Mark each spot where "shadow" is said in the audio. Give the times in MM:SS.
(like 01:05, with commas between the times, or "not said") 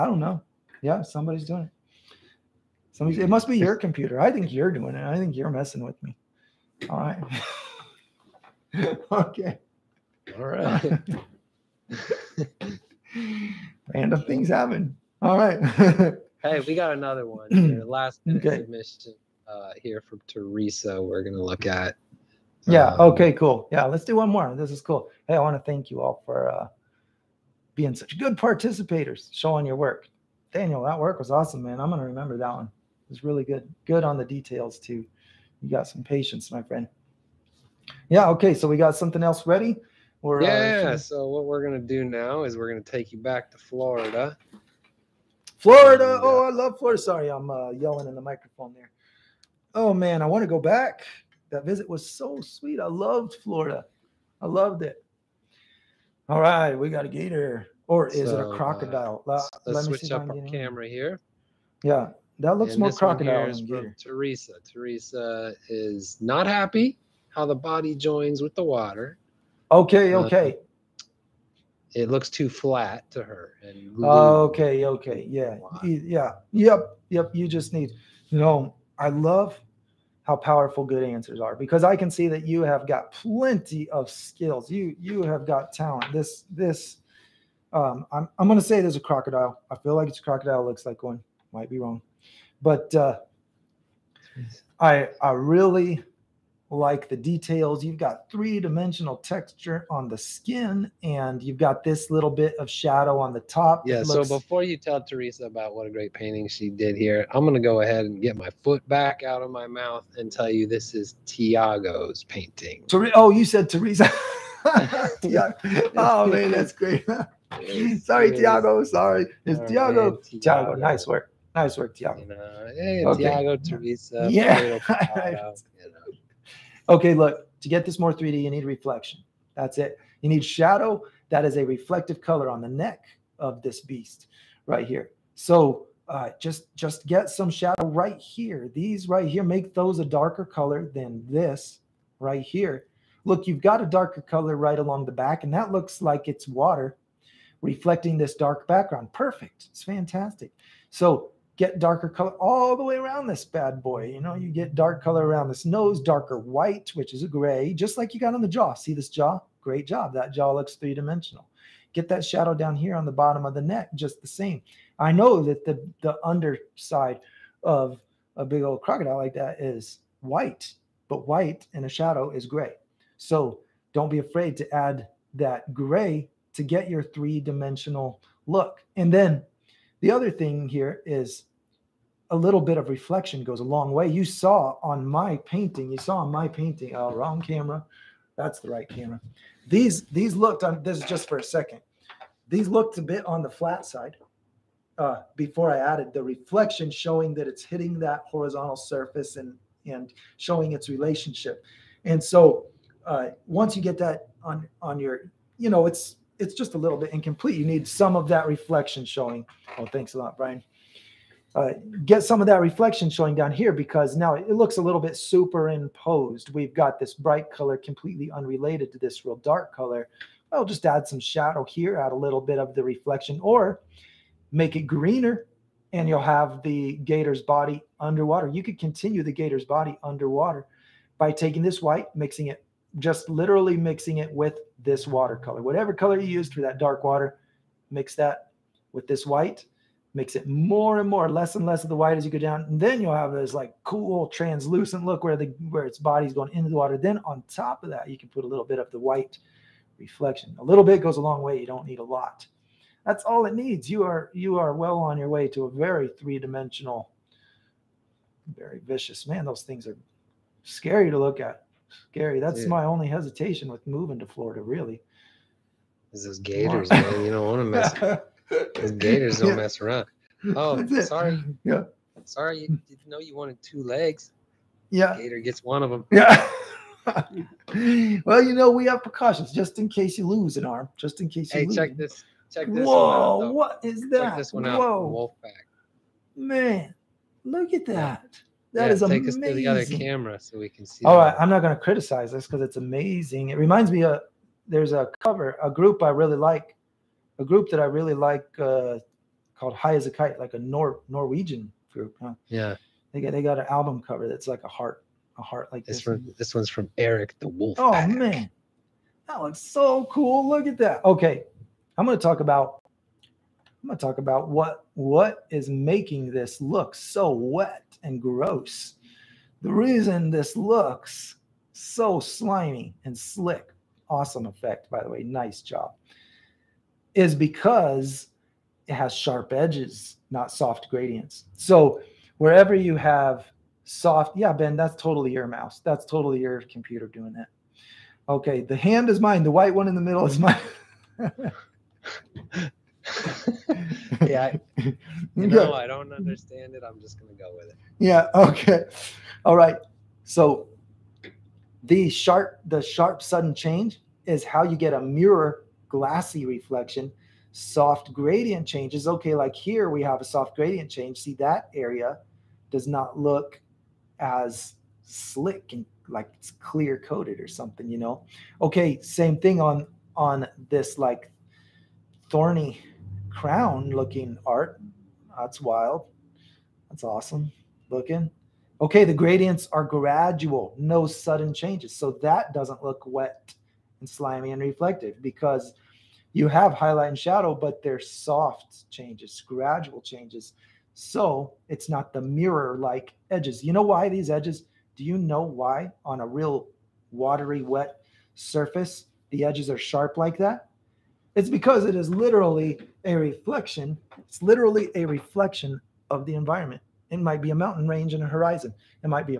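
01:42, 02:10, 02:17, 02:42, 02:51, 03:41, 06:27.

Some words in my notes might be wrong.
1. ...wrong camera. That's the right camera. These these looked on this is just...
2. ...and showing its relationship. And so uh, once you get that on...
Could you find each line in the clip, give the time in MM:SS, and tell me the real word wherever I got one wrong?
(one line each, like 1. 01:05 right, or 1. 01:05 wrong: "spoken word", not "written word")
1. 03:07 right
2. 03:19 right.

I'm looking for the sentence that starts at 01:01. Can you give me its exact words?
Yeah, that looks and more crocodile than gator.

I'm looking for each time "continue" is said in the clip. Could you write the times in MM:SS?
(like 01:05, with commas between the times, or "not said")
03:48.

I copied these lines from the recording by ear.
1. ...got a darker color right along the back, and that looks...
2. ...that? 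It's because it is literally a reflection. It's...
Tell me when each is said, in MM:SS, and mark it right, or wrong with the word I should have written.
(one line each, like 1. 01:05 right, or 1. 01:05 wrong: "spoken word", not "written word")
1. 02:23 right
2. 06:40 right.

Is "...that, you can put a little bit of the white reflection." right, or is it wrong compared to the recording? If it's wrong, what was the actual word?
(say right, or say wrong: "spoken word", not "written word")
right.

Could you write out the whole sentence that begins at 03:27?
You need some of that reflection showing.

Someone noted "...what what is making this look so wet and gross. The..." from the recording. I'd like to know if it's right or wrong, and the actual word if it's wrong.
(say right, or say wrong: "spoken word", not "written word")
right.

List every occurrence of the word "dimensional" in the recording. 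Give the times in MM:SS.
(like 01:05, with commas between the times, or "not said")
01:38, 02:40, 02:57, 04:16.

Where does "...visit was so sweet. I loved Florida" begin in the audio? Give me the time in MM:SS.
00:51.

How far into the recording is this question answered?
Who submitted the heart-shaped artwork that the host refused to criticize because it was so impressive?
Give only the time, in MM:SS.
05:06.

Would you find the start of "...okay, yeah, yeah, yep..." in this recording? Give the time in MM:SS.
01:14.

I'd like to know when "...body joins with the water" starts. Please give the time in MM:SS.
01:07.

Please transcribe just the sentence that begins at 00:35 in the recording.
You got some patience, my friend.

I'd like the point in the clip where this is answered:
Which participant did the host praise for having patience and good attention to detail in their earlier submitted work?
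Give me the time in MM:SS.
00:30.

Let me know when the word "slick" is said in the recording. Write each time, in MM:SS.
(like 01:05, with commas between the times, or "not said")
05:23, 06:05.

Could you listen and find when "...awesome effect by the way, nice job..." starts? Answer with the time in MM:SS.
05:24.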